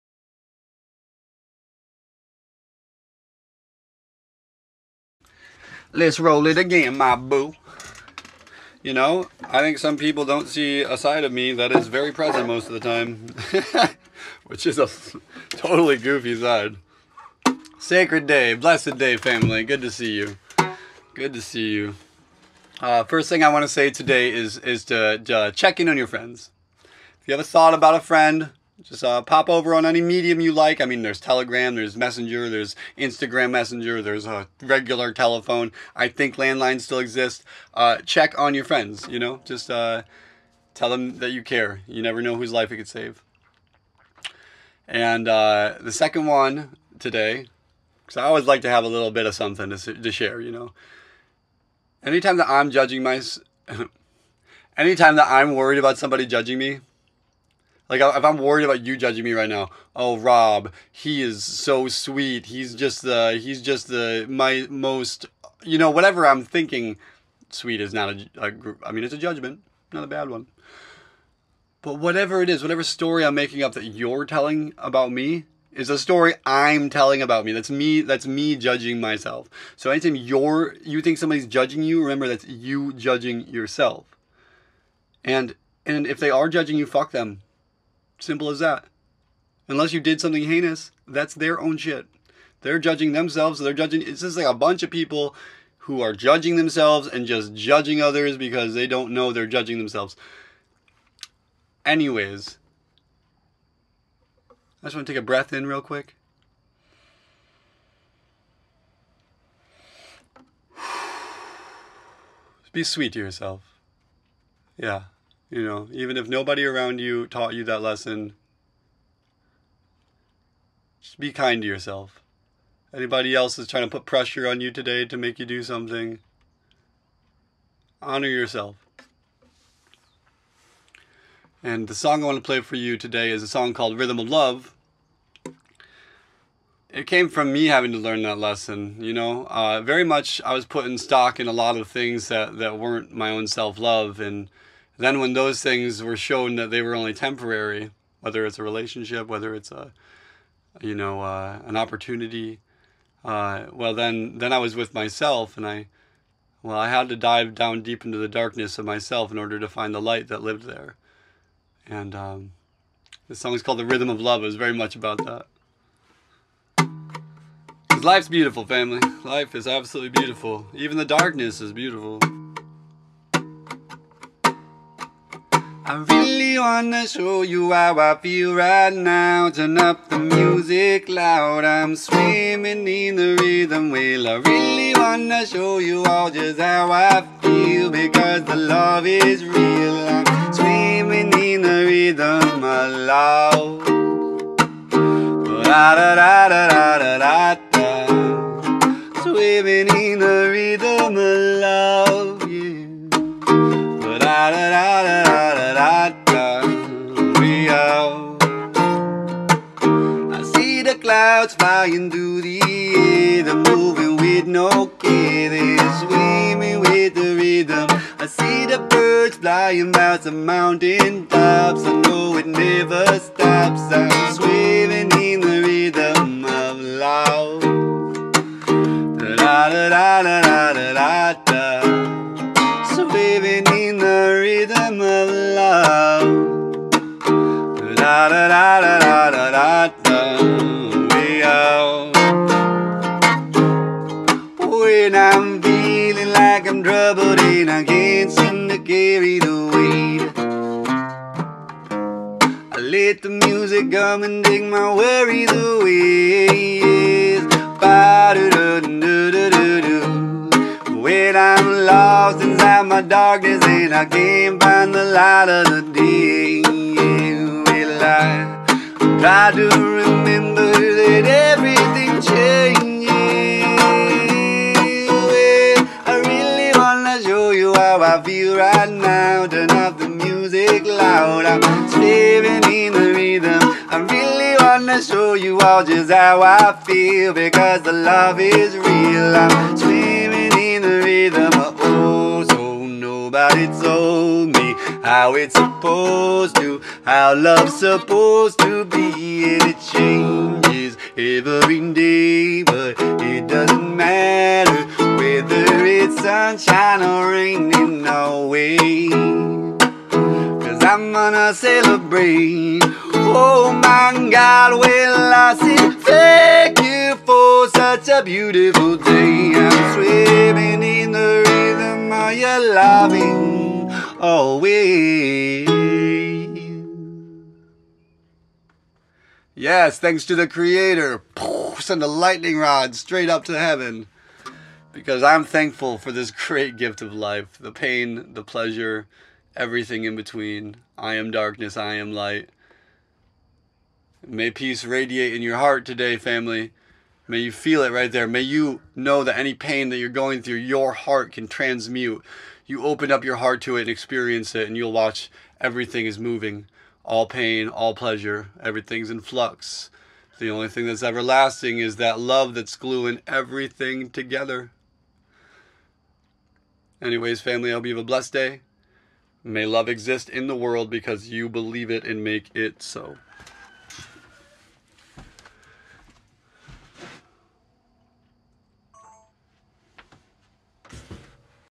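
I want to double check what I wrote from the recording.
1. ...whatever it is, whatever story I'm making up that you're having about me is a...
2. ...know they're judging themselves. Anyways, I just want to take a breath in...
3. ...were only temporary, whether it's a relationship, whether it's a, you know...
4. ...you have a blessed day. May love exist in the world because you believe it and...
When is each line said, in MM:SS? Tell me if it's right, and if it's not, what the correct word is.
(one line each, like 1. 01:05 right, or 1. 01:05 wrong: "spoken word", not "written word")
1. 01:11 wrong: "telling", not "having"
2. 01:39 right
3. 02:26 right
4. 06:07 right.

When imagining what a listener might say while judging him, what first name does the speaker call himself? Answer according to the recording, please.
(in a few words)
Rob.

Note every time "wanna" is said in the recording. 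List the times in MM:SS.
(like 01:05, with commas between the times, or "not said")
02:56, 03:04, 04:44.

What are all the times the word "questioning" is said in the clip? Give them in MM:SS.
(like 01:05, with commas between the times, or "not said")
not said.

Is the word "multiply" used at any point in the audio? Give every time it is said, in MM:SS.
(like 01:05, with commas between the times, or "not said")
not said.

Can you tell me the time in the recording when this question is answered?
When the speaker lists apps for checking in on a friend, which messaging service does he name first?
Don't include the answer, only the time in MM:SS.
00:31.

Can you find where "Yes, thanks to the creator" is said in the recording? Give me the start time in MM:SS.
05:29.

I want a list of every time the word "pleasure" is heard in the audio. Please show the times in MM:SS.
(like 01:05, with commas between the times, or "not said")
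05:38, 05:57.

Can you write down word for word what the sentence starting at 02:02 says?
Anybody else is trying to put pressure on you today to make you do something, honor yourself.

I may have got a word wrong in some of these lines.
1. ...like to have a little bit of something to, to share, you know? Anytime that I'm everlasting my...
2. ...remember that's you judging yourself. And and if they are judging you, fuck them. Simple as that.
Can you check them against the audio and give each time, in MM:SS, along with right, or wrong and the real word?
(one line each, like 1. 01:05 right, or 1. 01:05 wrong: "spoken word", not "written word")
1. 00:48 wrong: "judging", not "everlasting"
2. 01:22 right.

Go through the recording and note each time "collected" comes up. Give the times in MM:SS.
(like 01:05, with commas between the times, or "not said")
not said.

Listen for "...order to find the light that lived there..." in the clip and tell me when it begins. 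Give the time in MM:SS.
02:39.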